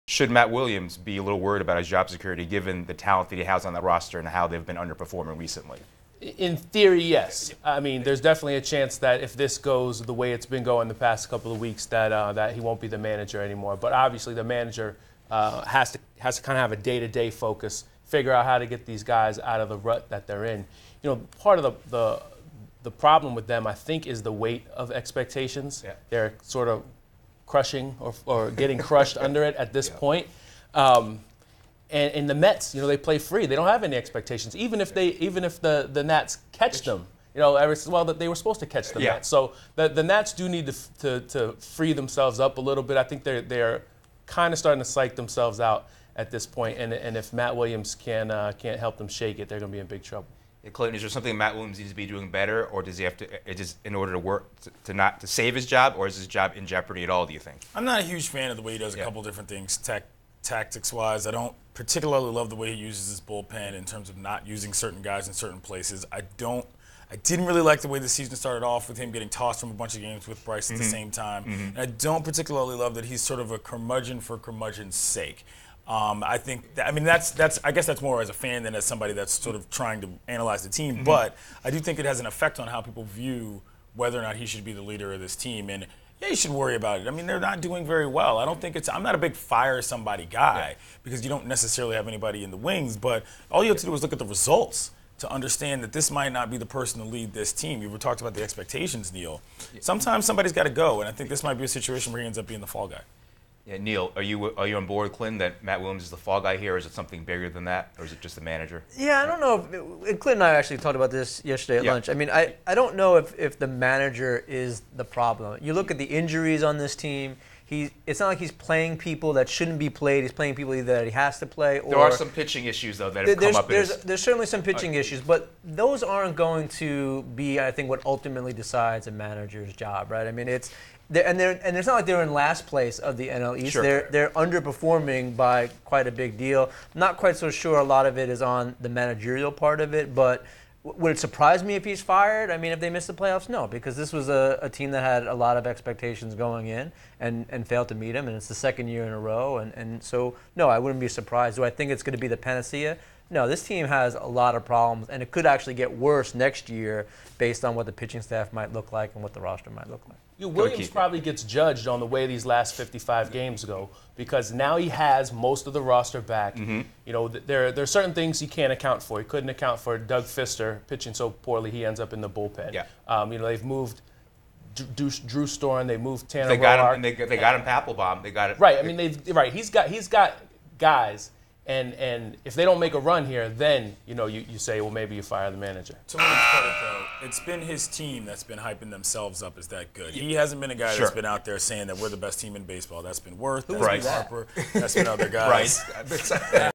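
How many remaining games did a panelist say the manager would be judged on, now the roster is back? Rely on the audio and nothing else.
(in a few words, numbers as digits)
55.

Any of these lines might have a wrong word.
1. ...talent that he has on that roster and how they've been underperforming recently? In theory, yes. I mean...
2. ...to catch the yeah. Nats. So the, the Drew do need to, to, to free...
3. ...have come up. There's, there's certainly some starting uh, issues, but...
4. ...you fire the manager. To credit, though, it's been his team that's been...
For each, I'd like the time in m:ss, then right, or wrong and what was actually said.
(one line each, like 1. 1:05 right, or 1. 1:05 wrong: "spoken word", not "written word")
1. 0:02 right
2. 0:38 wrong: "Nats", not "Drew"
3. 2:03 wrong: "pitching", not "starting"
4. 3:05 right.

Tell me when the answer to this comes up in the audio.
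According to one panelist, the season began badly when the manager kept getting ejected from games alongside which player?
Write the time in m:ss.
1:10.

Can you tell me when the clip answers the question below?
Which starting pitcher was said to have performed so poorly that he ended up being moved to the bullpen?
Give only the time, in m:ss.
2:49.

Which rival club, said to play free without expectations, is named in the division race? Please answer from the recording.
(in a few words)
Mets.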